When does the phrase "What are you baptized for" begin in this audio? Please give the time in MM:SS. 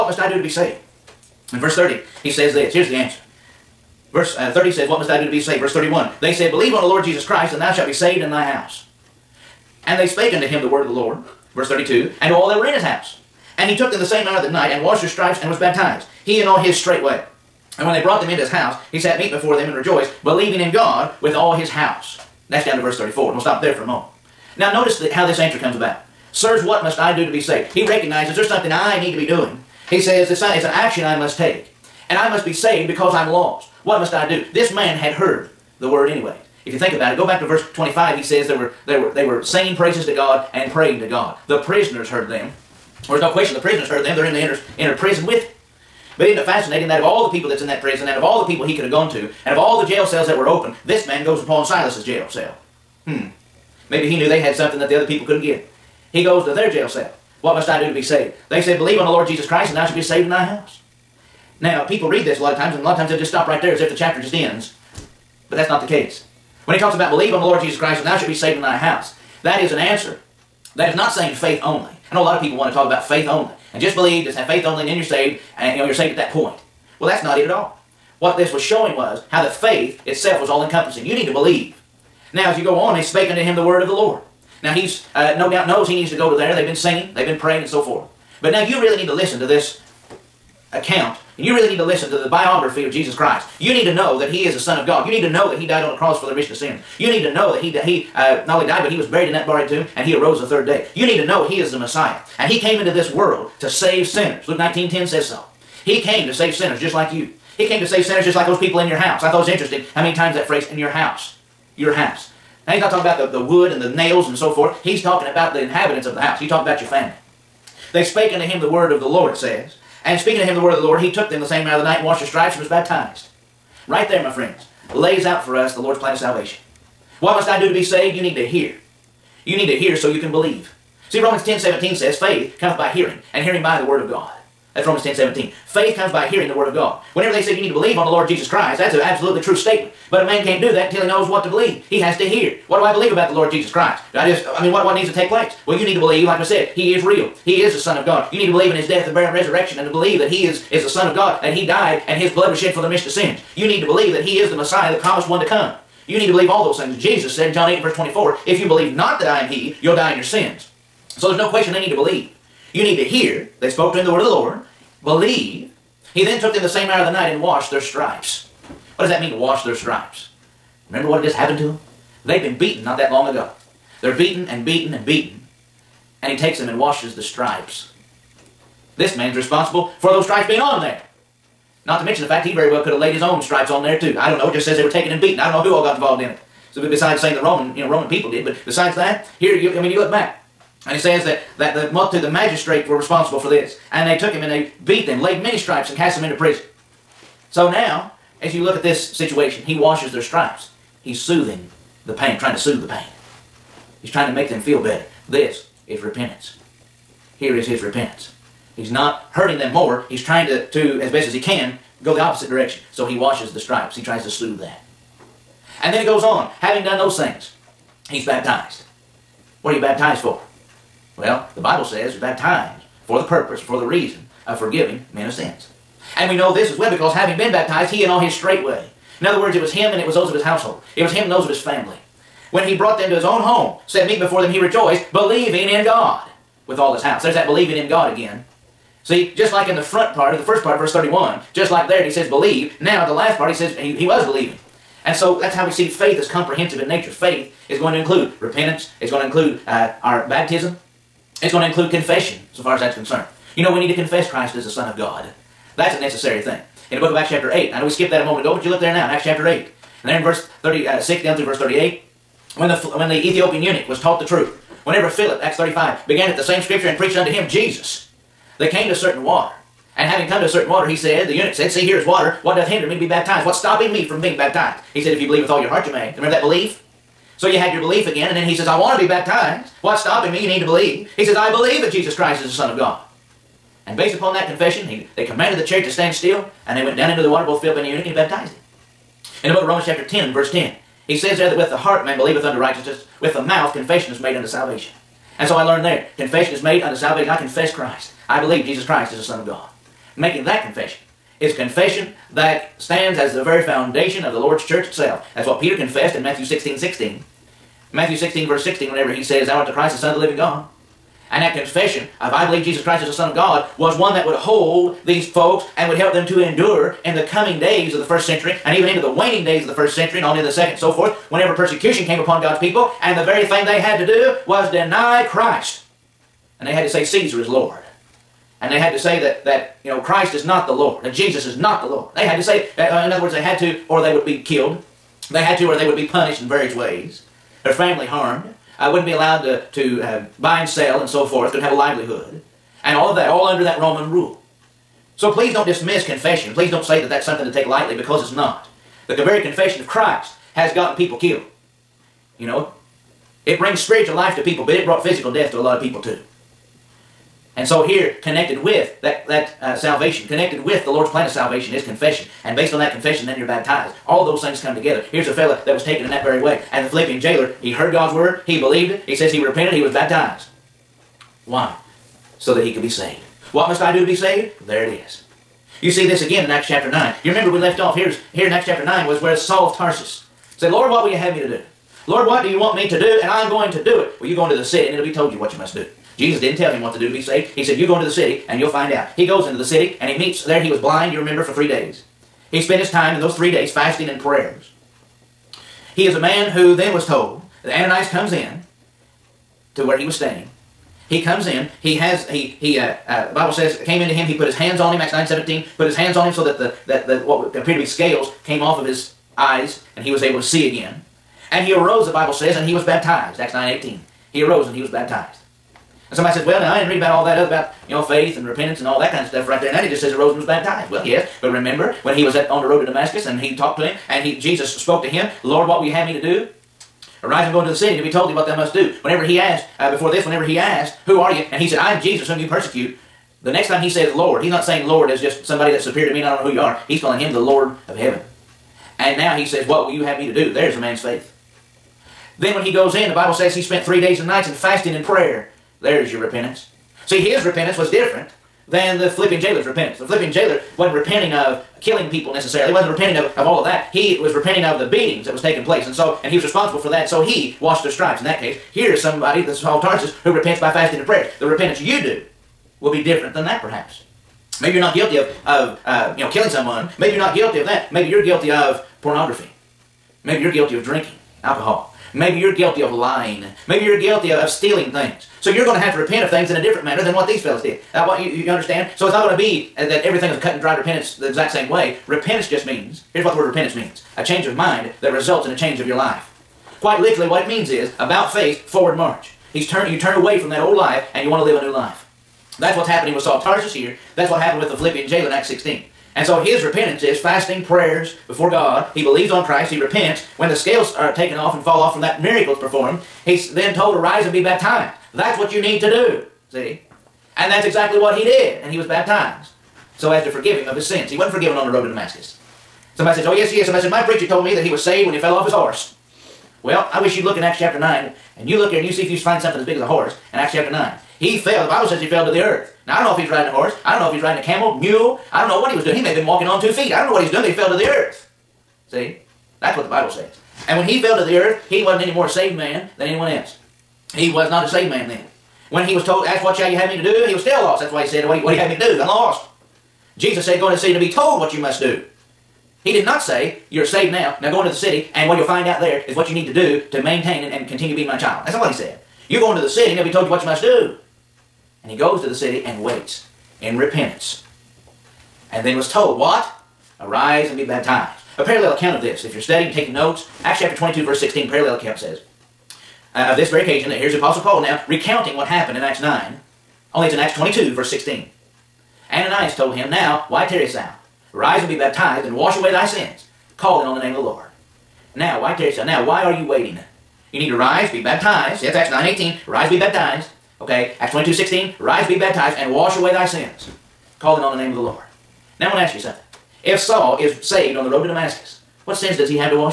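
03:39.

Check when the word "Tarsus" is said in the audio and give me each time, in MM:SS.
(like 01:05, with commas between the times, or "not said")
06:19, 07:39, 08:13.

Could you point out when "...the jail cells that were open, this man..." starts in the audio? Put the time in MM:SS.
00:49.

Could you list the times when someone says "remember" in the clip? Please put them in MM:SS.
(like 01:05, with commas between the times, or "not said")
02:50, 04:36, 06:17, 06:31, 07:01.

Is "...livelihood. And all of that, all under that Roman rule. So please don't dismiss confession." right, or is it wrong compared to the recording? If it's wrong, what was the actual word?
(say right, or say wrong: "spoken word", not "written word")
right.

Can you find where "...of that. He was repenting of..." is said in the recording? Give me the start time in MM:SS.
07:33.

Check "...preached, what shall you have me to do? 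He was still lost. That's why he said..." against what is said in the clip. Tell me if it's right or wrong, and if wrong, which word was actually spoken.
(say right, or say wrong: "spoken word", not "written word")
wrong: "asked", not "preached".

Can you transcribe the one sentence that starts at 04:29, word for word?
And having come to a certain water, he said, the eunuch said, See, here is water.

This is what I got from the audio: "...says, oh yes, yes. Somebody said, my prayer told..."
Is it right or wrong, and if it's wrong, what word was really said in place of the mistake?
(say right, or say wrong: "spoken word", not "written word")
wrong: "preacher", not "prayer".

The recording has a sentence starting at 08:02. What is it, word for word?
Repentance just means, here's what the word repentance means, a change of mind that results in a change of your life.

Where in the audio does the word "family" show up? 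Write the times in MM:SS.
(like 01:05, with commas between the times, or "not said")
01:56, 03:51, 05:37.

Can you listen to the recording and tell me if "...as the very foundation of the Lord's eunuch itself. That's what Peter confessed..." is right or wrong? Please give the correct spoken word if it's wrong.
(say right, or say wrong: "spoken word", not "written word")
wrong: "church", not "eunuch".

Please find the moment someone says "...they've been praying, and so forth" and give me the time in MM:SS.
01:27.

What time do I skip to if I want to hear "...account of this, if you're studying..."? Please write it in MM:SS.
09:18.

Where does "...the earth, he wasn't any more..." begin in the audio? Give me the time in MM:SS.
08:51.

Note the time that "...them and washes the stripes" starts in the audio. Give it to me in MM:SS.
02:56.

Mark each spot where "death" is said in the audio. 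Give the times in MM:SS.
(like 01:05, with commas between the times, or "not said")
02:28, 05:55.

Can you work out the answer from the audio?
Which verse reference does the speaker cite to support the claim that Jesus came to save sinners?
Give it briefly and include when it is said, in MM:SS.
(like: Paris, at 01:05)
Luke 19:10, at 01:44.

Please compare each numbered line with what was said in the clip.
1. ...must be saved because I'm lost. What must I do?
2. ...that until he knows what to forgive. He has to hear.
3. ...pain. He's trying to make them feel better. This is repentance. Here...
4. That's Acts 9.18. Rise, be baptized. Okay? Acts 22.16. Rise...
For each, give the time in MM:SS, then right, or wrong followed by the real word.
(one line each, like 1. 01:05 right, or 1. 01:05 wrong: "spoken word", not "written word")
1. 00:32 right
2. 02:20 wrong: "believe", not "forgive"
3. 03:22 right
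4. 09:38 right.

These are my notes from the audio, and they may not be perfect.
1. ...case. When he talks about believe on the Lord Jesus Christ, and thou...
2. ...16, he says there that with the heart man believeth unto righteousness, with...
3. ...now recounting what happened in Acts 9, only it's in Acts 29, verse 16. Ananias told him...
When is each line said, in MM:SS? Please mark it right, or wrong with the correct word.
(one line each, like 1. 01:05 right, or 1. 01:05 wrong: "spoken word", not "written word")
1. 01:05 right
2. 04:50 wrong: "10", not "16"
3. 09:24 wrong: "22", not "29".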